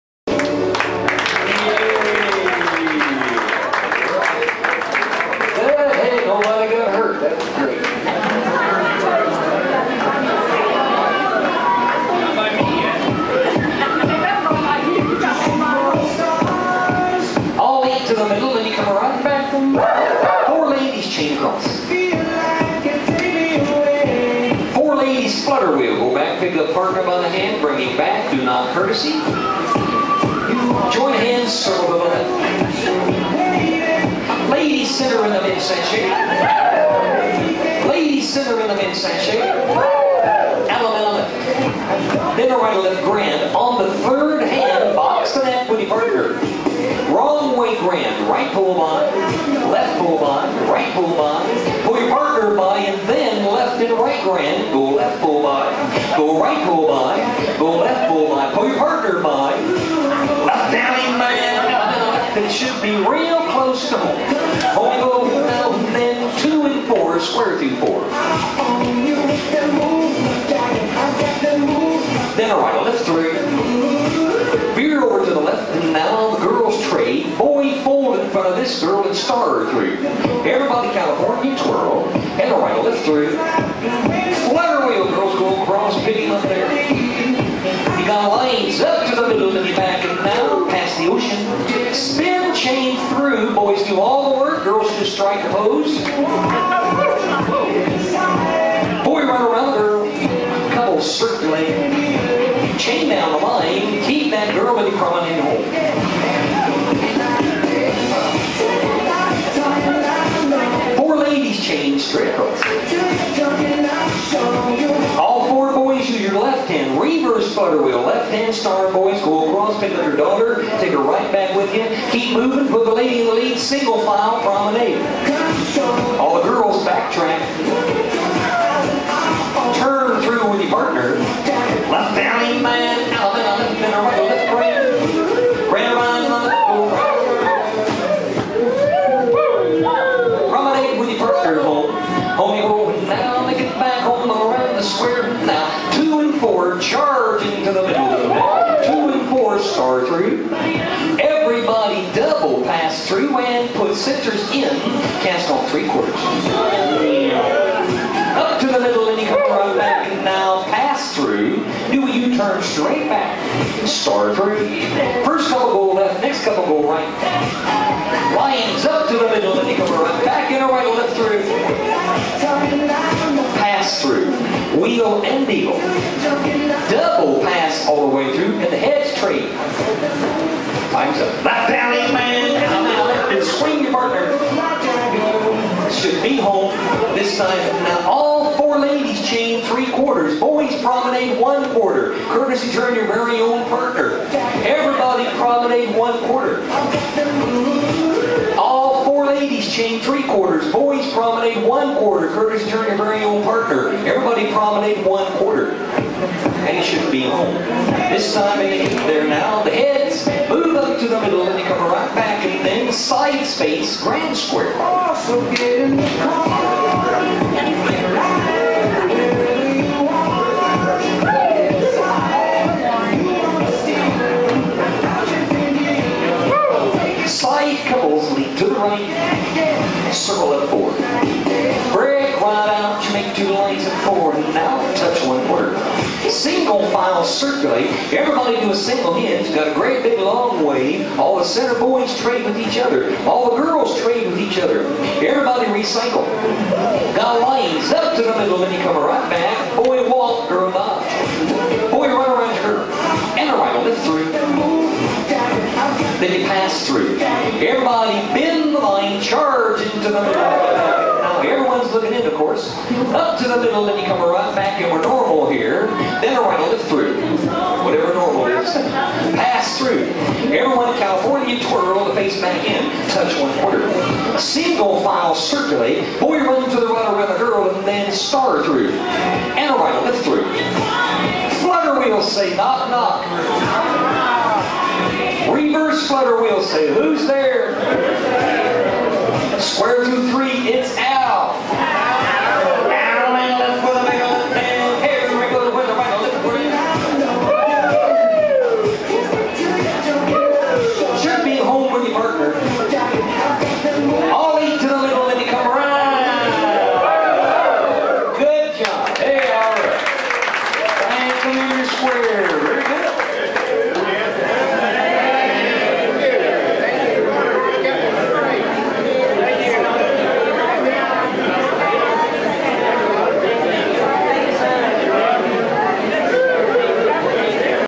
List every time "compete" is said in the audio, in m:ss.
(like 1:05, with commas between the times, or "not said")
not said.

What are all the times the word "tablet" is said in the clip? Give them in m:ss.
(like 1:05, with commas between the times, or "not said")
not said.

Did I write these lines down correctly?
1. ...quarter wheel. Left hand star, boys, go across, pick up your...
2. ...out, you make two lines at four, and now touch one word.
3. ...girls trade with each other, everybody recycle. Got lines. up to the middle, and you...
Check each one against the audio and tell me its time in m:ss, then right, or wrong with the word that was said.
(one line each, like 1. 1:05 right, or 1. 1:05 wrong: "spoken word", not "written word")
1. 1:57 wrong: "daughter", not "quarter"
2. 3:52 right
3. 4:03 right.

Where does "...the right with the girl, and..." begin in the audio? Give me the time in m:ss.
4:36.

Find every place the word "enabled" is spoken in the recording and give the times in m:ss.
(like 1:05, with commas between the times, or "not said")
not said.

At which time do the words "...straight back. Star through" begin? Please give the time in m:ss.
2:42.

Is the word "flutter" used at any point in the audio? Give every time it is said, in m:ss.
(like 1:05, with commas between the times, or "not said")
0:25, 1:24, 4:41.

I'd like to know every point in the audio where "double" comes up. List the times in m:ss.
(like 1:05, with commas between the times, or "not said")
2:32, 2:57.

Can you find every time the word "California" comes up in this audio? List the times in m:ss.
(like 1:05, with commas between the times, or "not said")
1:20, 4:30.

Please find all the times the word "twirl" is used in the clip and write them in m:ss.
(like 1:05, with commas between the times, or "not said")
1:21, 4:31.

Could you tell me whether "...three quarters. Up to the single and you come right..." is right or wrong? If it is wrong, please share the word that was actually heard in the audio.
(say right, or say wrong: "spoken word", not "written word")
wrong: "middle", not "single".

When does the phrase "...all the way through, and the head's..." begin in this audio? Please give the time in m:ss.
2:57.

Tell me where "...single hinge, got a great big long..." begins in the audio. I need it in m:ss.
3:58.